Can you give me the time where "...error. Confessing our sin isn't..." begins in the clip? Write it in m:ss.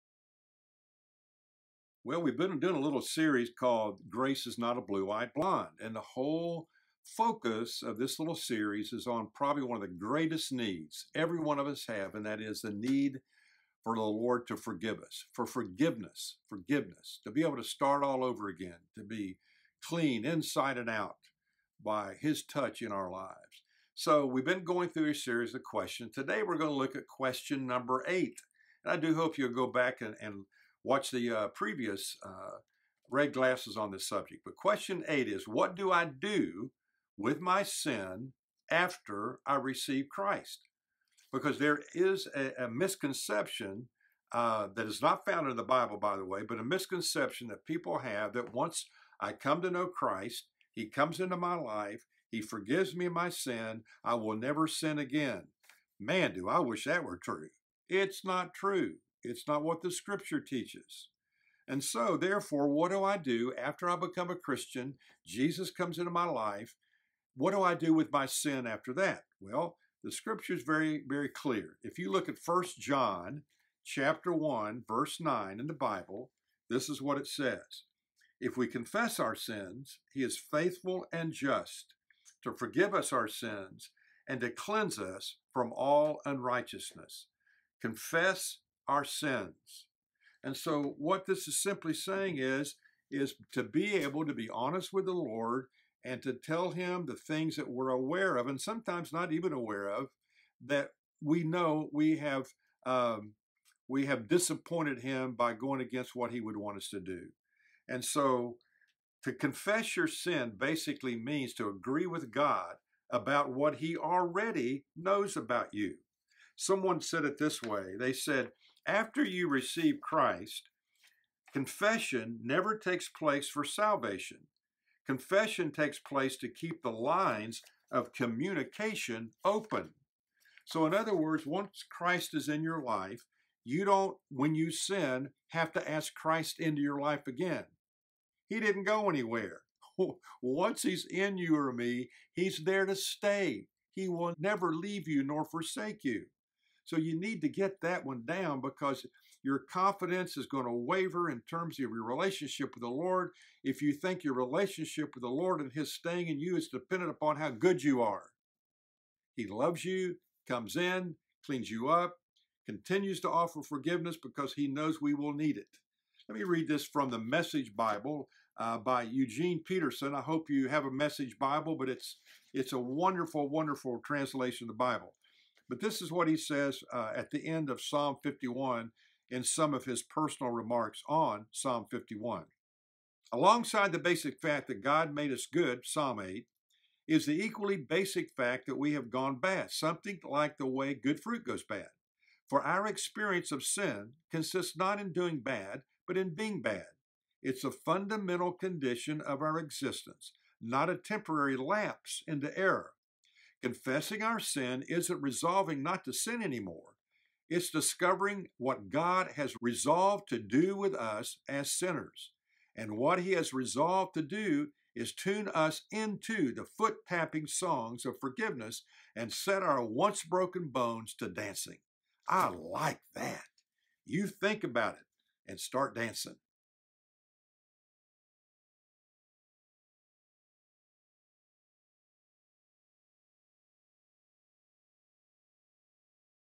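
3:22.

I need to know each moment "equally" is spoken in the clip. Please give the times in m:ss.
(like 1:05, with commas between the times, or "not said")
3:07.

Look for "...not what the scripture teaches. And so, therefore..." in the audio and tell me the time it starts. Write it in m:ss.
0:59.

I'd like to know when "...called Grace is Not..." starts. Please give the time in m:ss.
0:03.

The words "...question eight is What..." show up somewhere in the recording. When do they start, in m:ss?
0:34.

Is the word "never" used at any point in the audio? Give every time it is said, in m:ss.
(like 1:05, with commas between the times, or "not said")
0:54, 2:02, 2:24.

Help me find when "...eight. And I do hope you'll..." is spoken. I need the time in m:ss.
0:28.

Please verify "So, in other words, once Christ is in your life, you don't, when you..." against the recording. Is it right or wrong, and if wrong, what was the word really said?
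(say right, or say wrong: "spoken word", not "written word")
right.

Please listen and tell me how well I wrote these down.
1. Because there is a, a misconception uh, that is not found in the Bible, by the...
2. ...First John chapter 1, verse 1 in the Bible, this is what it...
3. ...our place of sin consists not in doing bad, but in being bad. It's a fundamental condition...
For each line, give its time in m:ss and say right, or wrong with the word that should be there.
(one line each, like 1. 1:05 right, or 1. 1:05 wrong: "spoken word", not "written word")
1. 0:41 right
2. 1:12 wrong: "9", not "1"
3. 3:12 wrong: "experience", not "place".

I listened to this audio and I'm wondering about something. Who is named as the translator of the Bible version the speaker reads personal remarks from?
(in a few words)
Eugene Peterson.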